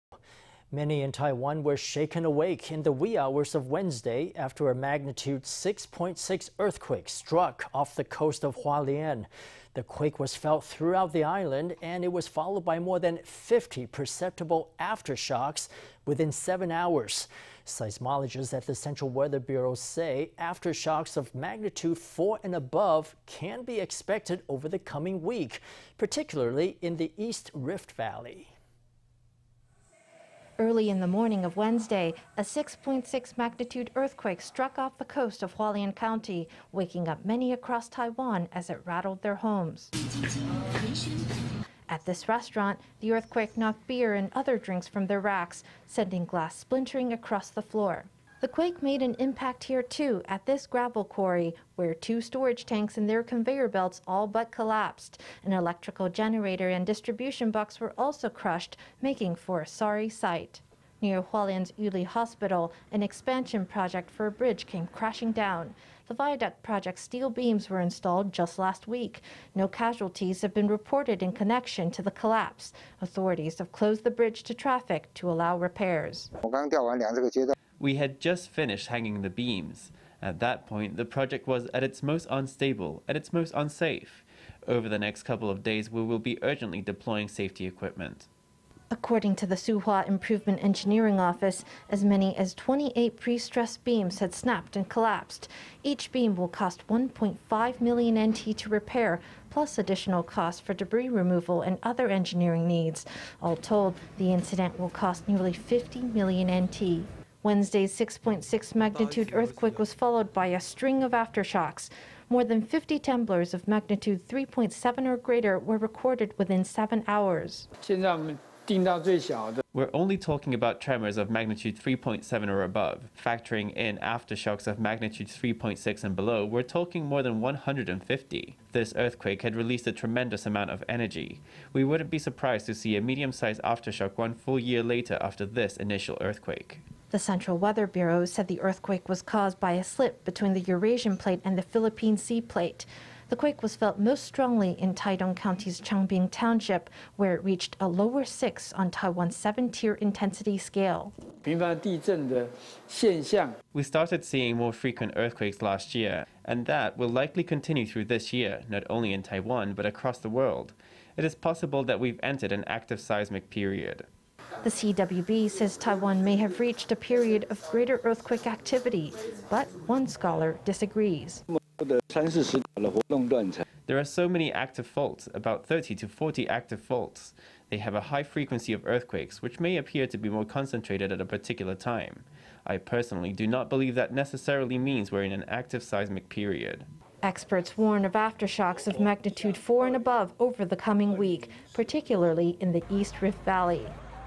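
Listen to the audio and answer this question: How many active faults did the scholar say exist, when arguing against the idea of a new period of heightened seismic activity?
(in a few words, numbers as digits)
30 to 40.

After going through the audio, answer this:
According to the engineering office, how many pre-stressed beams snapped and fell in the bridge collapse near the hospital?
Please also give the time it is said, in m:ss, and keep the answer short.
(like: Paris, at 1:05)
28, at 1:32.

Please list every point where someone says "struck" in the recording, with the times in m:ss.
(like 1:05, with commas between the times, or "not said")
0:07, 0:34.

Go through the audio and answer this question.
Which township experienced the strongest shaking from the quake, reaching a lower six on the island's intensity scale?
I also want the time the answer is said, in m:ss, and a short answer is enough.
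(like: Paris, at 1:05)
Changbin Township, at 2:25.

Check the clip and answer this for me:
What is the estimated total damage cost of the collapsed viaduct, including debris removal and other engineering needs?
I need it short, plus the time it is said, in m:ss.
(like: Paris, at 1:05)
nearly 50 million NT, at 1:45.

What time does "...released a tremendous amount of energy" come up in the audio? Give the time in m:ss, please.
2:09.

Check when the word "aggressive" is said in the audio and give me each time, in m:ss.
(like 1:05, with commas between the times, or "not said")
not said.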